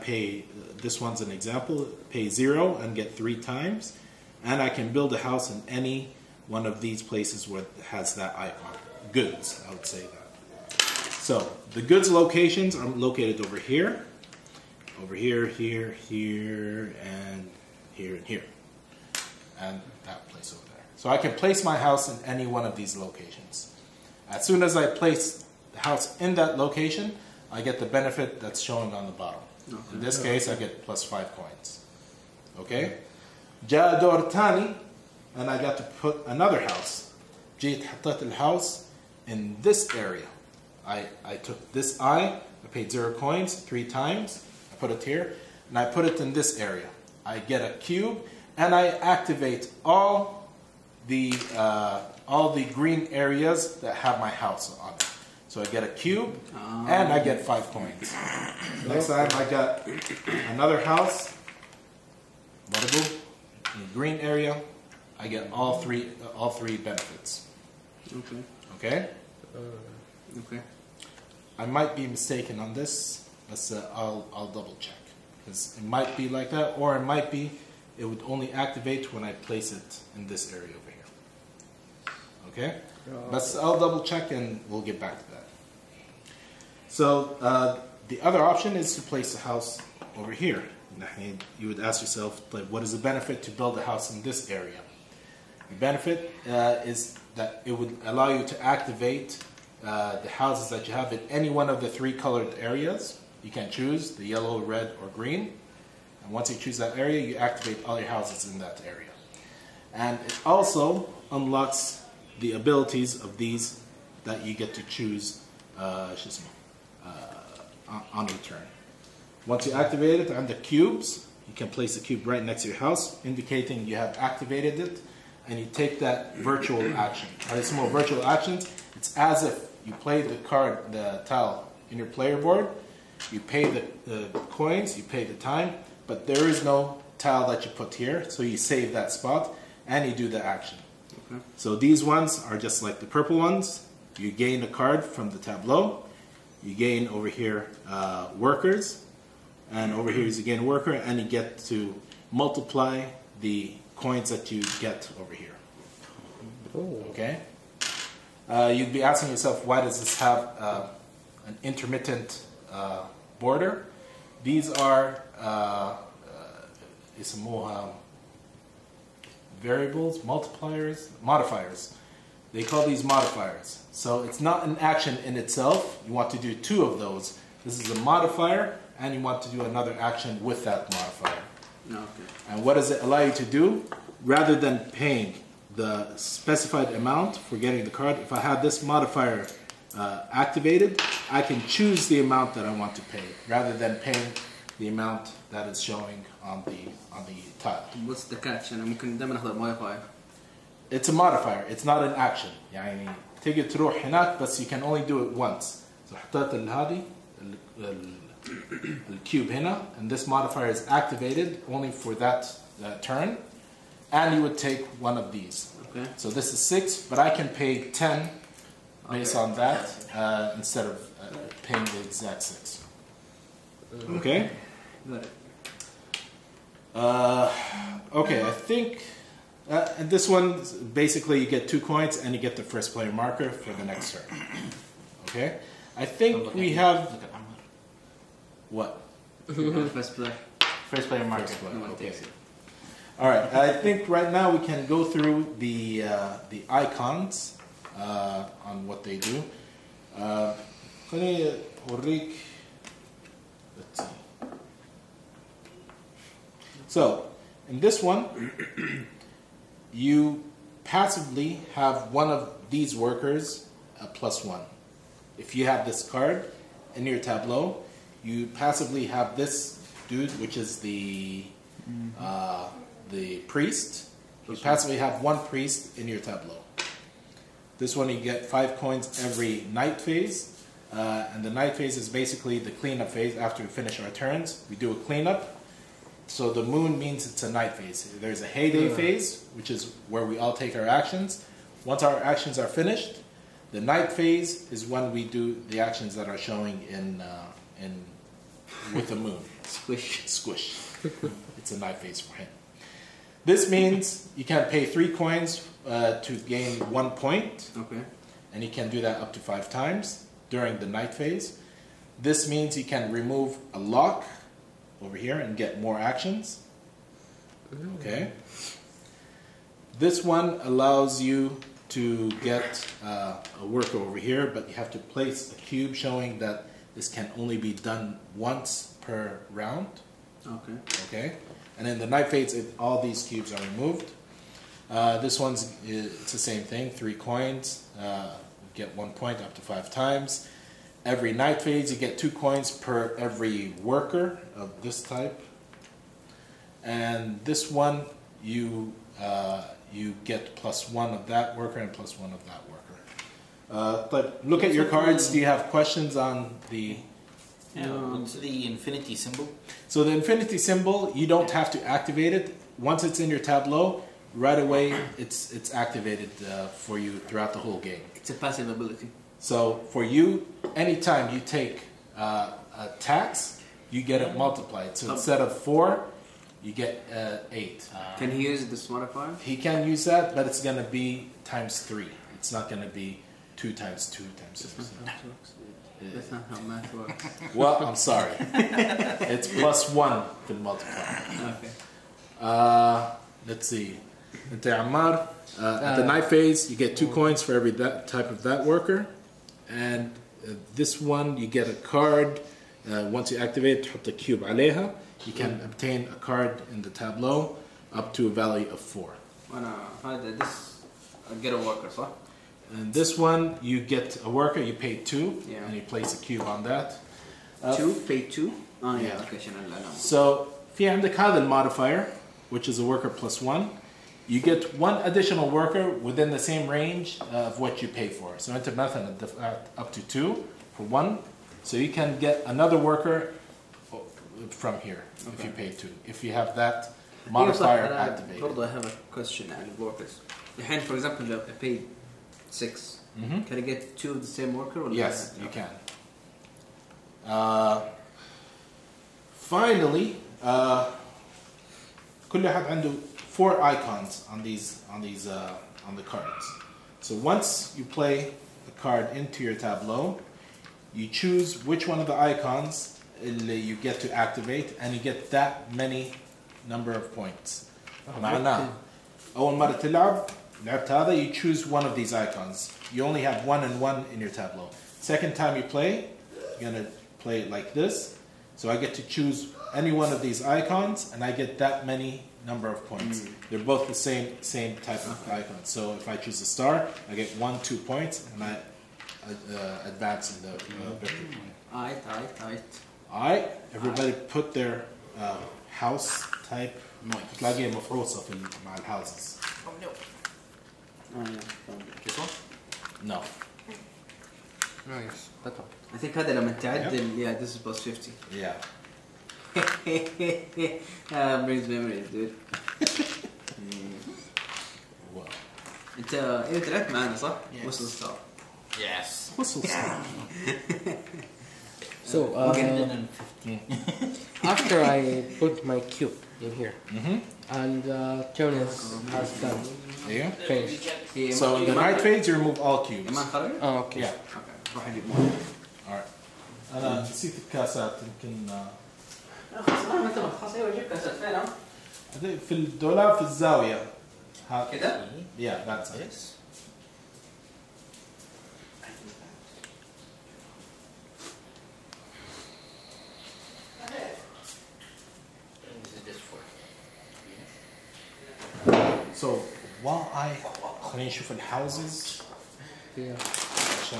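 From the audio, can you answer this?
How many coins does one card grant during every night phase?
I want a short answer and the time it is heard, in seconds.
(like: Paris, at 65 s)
5, at 278 s.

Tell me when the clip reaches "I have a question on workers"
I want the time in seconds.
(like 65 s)
438 s.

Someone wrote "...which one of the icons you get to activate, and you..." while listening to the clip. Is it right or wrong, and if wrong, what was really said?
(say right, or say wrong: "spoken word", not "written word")
right.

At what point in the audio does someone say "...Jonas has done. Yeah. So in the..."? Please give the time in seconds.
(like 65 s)
528 s.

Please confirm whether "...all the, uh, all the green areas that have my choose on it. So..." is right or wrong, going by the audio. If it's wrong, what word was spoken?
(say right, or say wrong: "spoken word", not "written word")
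wrong: "house", not "choose".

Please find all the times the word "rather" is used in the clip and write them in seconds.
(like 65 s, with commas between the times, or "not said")
184 s, 193 s.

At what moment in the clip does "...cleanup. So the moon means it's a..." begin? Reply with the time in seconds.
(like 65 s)
284 s.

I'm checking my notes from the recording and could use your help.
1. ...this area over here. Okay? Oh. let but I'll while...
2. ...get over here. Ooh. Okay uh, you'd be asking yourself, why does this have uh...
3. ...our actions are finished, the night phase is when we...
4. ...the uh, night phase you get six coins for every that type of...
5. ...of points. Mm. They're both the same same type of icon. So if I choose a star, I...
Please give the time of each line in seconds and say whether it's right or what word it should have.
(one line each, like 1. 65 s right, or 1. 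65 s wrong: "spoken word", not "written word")
1. 80 s wrong: "double", not "while"
2. 154 s right
3. 292 s right
4. 395 s wrong: "two", not "six"
5. 482 s right.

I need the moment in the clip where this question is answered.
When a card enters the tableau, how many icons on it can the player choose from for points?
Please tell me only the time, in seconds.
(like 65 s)
453 s.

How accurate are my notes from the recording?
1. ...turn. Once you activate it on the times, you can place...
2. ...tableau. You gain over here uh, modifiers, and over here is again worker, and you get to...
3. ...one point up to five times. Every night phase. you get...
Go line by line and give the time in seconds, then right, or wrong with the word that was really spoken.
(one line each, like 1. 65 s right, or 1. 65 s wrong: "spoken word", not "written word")
1. 118 s wrong: "cubes", not "times"
2. 145 s wrong: "workers", not "modifiers"
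3. 338 s right.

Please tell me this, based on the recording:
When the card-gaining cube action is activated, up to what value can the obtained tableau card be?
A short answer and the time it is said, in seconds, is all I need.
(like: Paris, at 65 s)
4, at 407 s.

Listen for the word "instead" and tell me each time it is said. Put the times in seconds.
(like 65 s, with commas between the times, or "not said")
220 s, 375 s.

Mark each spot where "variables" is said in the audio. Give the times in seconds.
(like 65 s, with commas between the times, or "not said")
169 s.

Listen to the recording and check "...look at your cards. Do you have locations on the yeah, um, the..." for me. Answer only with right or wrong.
wrong.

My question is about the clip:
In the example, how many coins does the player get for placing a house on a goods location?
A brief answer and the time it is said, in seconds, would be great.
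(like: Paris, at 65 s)
5, at 30 s.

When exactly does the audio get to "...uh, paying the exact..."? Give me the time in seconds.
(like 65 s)
221 s.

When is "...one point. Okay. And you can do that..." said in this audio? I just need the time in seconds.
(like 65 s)
306 s.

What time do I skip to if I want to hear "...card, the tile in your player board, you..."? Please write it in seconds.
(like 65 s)
130 s.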